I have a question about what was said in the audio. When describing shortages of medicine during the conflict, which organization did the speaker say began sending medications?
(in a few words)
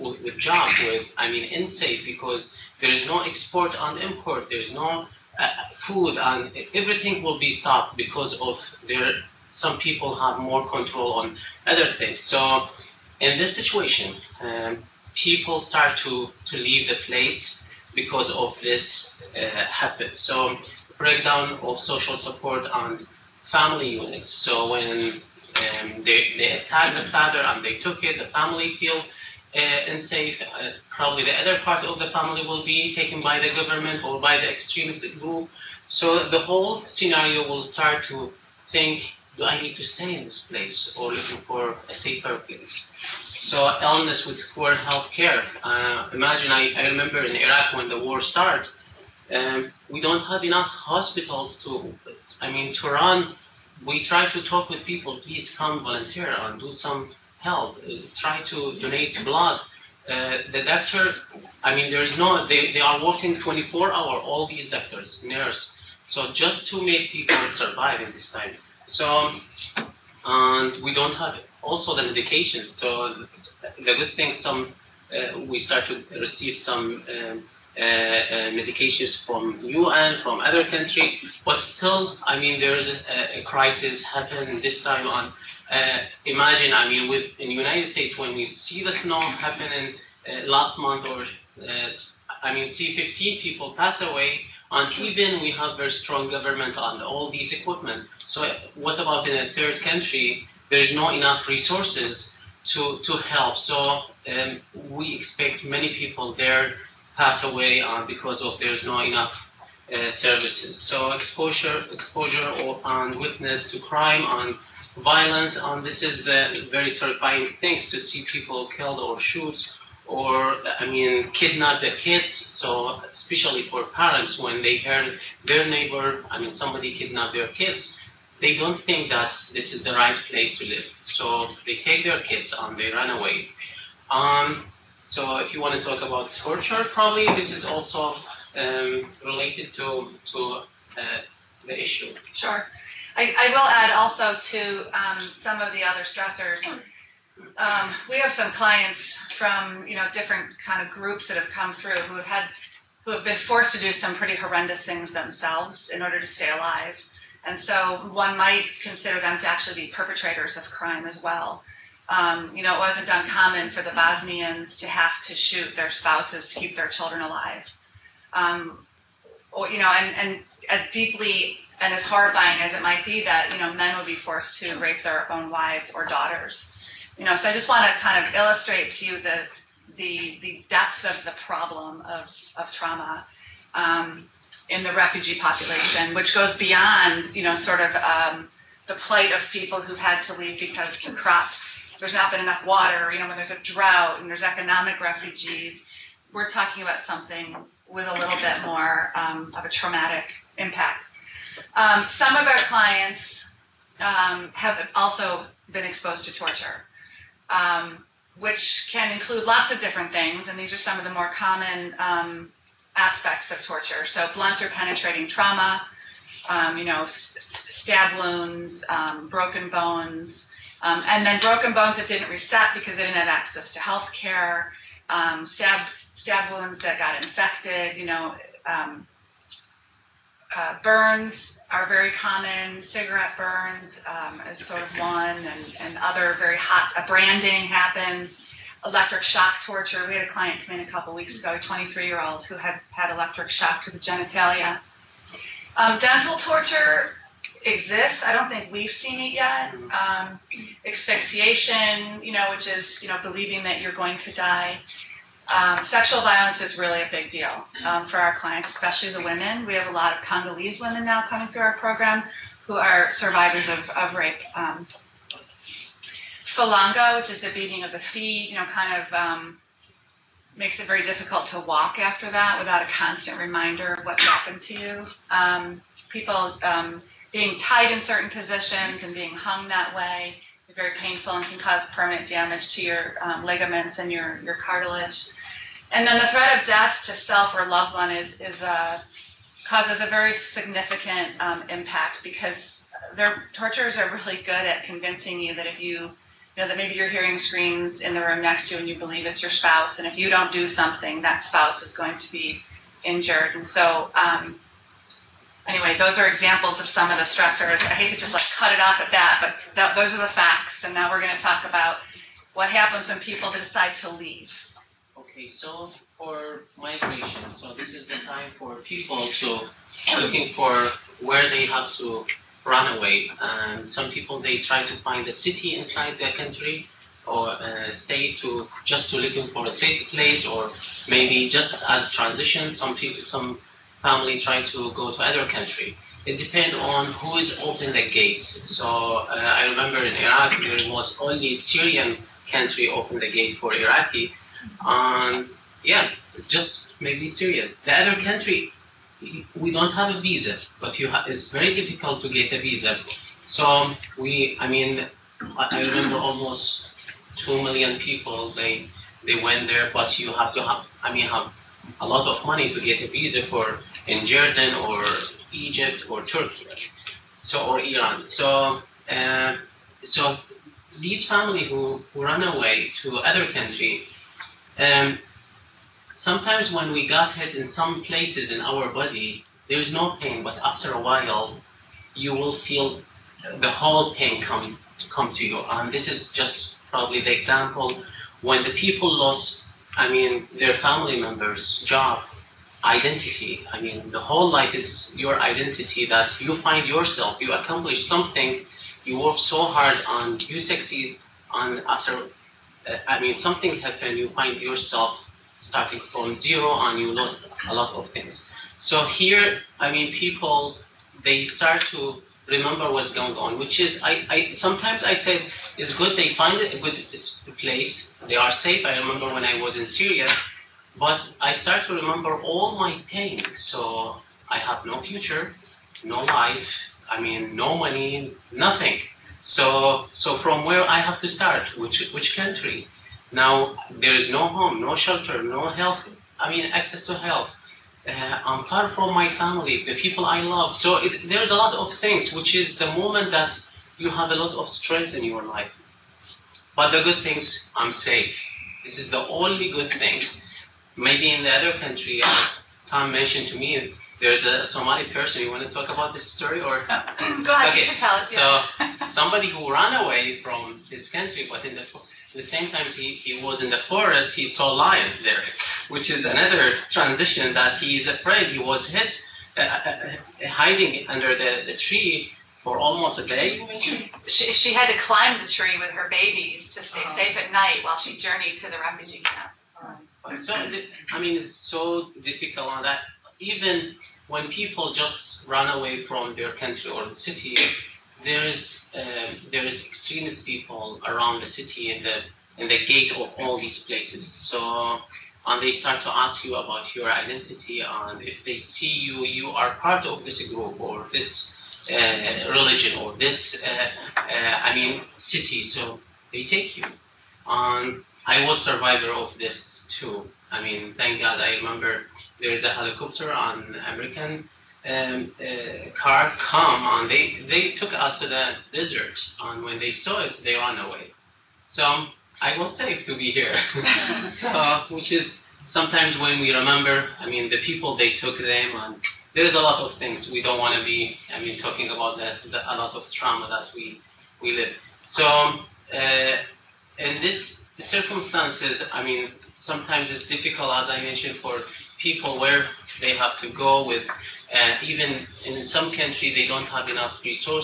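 UN.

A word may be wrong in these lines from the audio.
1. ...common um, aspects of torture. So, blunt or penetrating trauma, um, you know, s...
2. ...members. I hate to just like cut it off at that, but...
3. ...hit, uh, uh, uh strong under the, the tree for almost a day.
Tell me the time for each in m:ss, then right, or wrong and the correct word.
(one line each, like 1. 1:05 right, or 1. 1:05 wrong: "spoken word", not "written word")
1. 3:31 right
2. 5:07 wrong: "stressors", not "members"
3. 7:48 wrong: "hiding", not "strong".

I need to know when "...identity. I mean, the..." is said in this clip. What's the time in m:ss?
6:32.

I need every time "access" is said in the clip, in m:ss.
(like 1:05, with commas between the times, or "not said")
3:43, 7:16.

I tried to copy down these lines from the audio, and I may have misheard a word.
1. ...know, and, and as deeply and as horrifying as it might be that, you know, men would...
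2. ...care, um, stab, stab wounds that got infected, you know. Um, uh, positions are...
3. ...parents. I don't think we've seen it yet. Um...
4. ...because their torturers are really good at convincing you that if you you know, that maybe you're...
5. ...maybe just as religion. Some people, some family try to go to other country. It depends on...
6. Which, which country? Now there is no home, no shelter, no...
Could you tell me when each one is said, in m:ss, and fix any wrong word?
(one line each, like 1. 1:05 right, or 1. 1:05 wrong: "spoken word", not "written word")
1. 2:49 right
2. 3:44 wrong: "burns", not "positions"
3. 4:07 wrong: "exists", not "parents"
4. 4:52 right
5. 5:31 wrong: "transition", not "religion"
6. 7:11 right.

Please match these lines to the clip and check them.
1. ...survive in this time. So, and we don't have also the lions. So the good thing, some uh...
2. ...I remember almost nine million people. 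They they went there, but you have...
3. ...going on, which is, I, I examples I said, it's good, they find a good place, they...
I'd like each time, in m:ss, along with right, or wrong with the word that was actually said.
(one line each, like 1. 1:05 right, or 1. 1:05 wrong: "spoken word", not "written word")
1. 1:07 wrong: "medications", not "lions"
2. 5:55 wrong: "two", not "nine"
3. 6:53 wrong: "sometimes", not "examples".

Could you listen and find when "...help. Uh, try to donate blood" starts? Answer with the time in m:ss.
0:57.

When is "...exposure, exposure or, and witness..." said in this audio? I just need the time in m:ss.
1:51.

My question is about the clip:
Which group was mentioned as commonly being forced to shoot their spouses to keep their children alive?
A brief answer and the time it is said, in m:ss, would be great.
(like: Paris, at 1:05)
Bosnians, at 2:43.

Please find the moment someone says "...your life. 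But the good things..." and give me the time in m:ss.
7:25.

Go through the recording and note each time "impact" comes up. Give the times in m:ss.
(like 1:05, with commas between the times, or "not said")
3:20, 4:51.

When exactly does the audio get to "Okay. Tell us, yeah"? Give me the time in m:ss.
7:37.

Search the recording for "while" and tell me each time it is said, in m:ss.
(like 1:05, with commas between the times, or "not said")
6:21, 7:57.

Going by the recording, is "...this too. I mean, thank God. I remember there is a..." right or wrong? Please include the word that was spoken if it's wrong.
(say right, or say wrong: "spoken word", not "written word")
right.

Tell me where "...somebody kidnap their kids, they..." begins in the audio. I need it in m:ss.
2:06.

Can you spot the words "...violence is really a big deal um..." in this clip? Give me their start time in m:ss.
4:16.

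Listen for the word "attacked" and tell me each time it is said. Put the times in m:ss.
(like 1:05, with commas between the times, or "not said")
0:26.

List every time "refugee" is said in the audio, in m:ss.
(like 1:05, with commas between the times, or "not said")
3:04, 3:15, 7:58.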